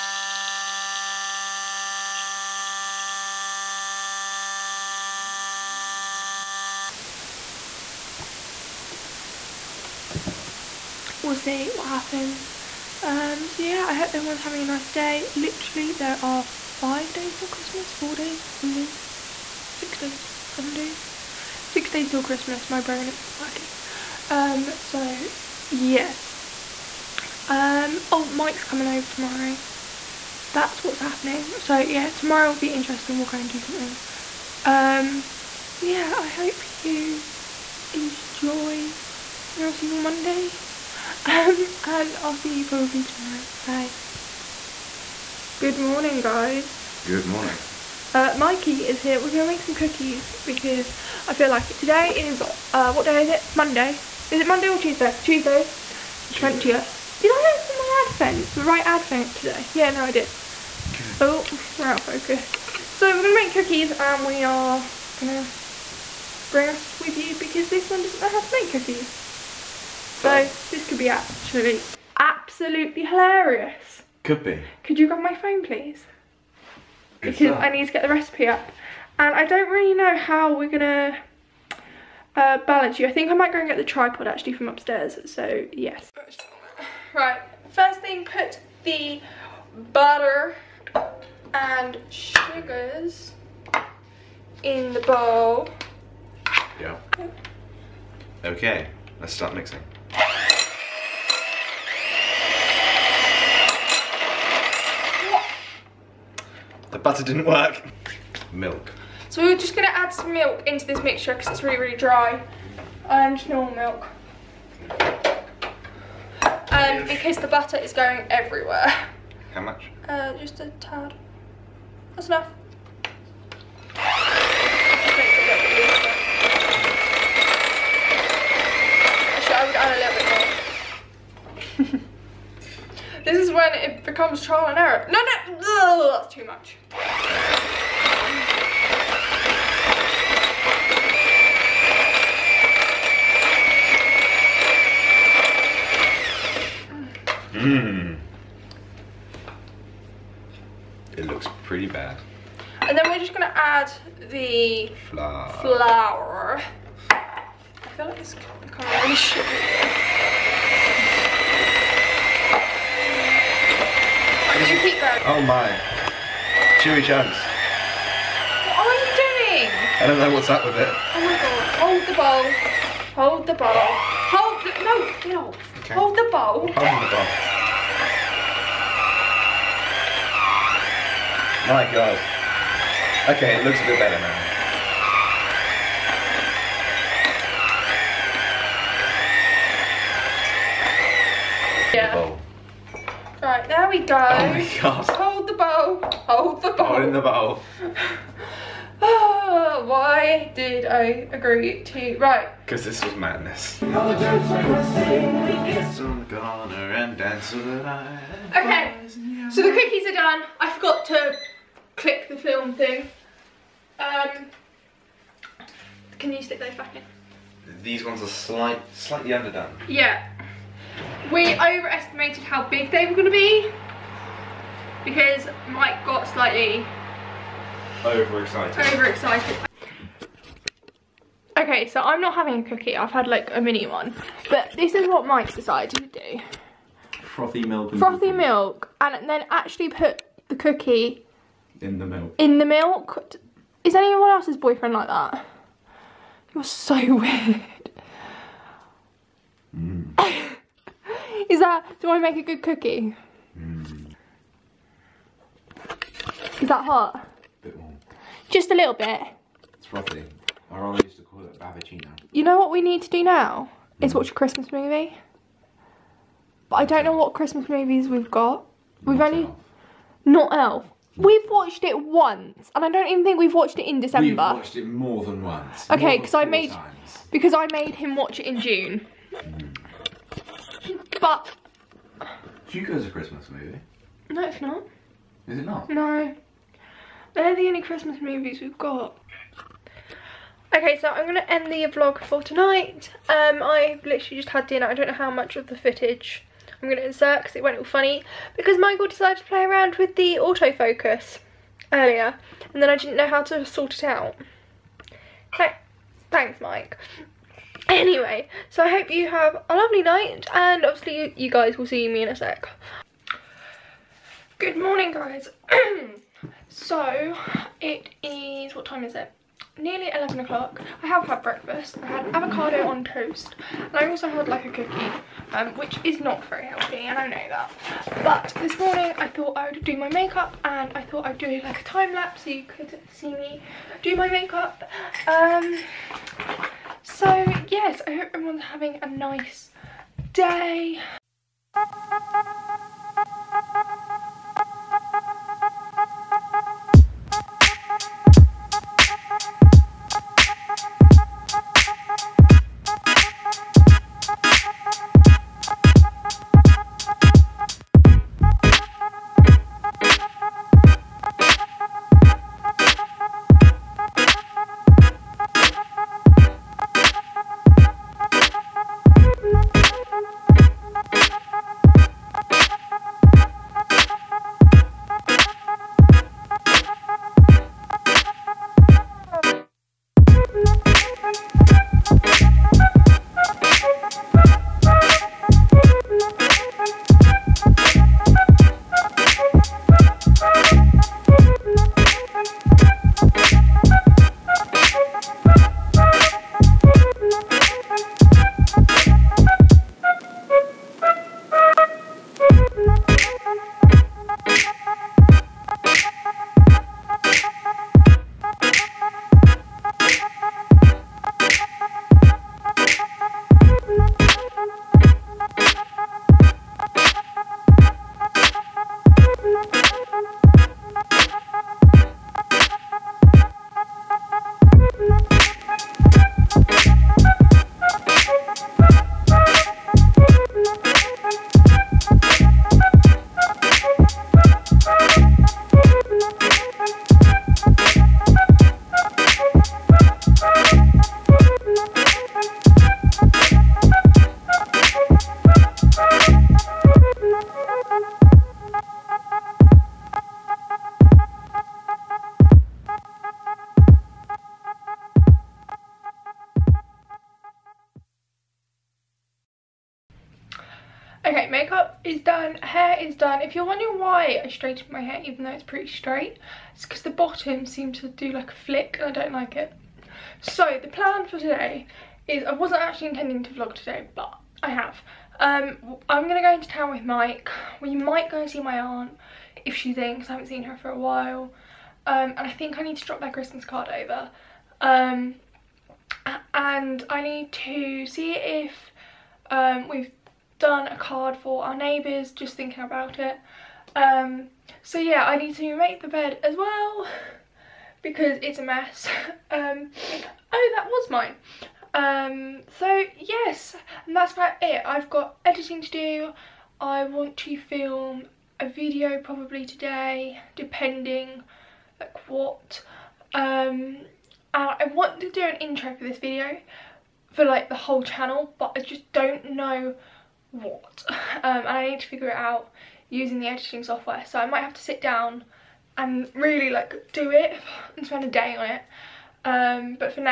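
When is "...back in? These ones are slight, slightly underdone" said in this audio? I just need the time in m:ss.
3:36.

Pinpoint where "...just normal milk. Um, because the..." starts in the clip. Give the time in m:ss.
1:53.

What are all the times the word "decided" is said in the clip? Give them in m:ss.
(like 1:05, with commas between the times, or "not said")
3:55, 4:59.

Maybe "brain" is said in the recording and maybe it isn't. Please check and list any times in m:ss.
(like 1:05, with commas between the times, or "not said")
0:22.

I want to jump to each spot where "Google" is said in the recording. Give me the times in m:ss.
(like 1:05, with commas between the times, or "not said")
not said.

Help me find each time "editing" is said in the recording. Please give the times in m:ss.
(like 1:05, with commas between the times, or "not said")
8:25, 8:43.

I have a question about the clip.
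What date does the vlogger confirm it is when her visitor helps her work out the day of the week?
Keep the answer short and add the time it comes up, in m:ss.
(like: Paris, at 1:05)
Tuesday the 20th, at 0:55.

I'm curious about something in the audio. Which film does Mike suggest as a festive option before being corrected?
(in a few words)
Hugo.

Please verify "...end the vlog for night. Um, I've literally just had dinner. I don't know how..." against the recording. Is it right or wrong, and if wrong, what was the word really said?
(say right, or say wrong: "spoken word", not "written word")
wrong: "tonight", not "night".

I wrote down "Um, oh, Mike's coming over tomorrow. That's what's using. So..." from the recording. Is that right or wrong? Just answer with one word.
wrong.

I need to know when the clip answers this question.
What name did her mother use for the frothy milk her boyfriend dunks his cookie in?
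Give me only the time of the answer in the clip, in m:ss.
4:21.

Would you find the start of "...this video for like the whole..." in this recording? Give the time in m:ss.
8:36.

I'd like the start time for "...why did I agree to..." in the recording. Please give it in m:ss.
3:19.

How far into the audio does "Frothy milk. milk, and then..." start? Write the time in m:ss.
3:57.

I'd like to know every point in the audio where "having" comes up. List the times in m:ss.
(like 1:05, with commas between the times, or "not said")
0:14, 3:52, 5:38.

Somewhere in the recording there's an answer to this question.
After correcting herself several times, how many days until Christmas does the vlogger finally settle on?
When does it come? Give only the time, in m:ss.
0:21.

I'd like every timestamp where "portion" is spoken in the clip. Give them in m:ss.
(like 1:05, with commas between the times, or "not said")
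not said.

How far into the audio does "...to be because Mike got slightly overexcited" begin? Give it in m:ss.
3:43.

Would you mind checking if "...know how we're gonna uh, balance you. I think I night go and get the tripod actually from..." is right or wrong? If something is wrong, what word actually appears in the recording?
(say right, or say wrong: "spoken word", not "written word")
wrong: "might", not "night".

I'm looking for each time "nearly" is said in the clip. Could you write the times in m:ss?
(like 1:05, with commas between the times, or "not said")
5:19.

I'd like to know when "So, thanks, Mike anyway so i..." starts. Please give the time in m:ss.
5:05.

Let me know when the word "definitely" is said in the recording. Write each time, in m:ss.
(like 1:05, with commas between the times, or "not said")
not said.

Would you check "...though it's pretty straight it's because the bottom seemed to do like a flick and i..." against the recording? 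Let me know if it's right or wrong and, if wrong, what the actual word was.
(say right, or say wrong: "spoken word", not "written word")
right.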